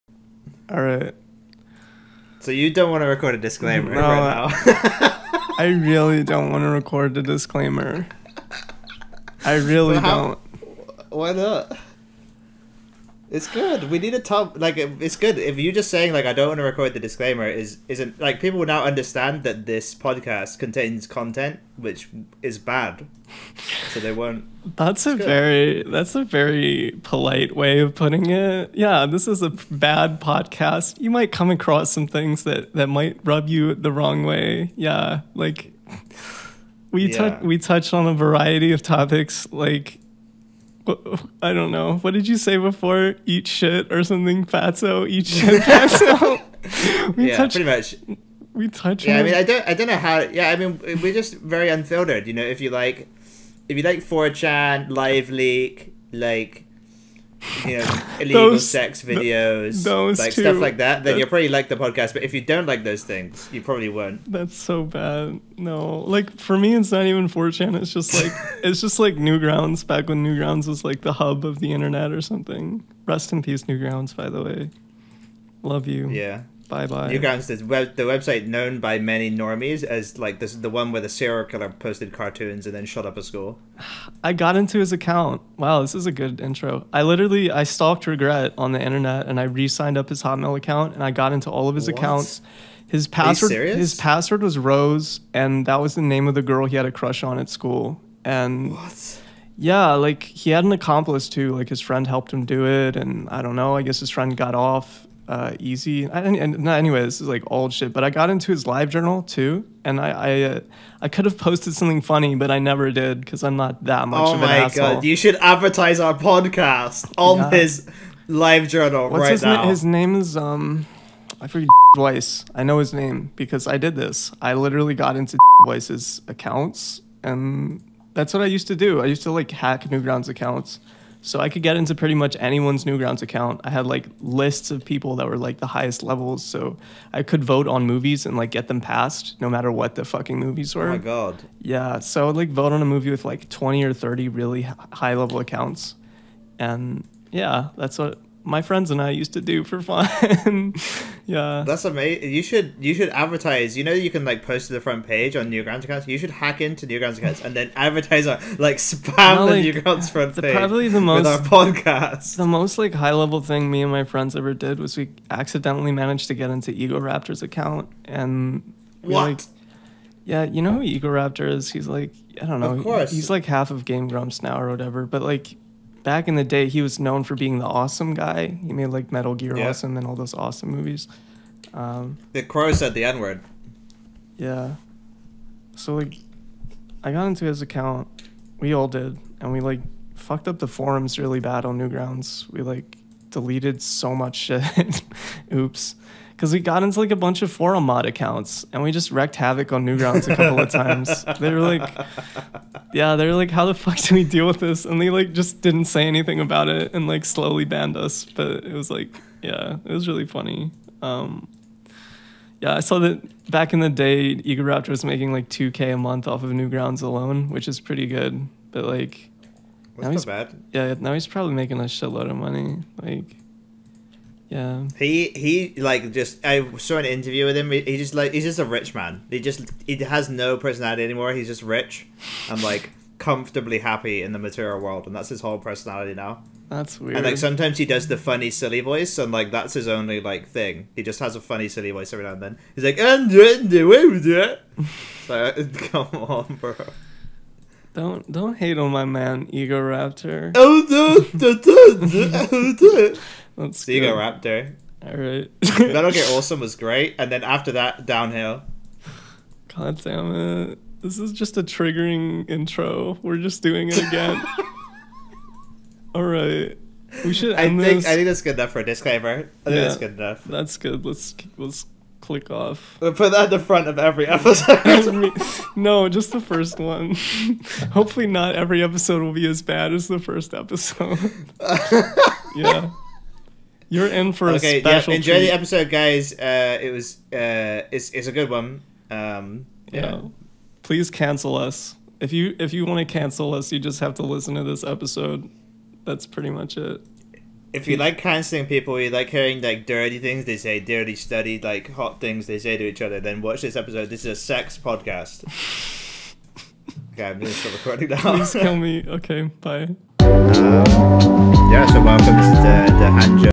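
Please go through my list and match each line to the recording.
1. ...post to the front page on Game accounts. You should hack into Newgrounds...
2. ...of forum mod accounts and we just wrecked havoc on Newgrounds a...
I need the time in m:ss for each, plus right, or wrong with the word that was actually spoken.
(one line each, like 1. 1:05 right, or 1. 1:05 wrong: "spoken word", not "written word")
1. 2:34 wrong: "Newgrounds", not "Game"
2. 3:17 right.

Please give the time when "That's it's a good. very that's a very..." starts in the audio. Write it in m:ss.
0:24.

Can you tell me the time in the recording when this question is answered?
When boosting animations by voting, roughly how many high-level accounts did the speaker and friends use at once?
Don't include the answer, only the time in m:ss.
2:23.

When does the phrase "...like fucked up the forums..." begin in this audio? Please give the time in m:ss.
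3:09.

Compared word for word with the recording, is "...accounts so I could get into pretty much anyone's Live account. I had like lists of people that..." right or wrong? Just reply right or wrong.
wrong.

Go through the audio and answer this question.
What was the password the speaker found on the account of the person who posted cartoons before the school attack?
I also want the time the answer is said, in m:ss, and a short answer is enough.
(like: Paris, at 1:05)
Rose, at 1:34.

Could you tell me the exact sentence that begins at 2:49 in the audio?
Like, yeah, you know who Ego Raptor is?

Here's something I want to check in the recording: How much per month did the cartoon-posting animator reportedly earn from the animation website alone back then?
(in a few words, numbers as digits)
2K.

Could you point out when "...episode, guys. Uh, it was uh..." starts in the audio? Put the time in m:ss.
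4:45.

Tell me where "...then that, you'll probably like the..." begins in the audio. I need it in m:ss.
1:01.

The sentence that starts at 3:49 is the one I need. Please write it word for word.
He just he has no personality anymore.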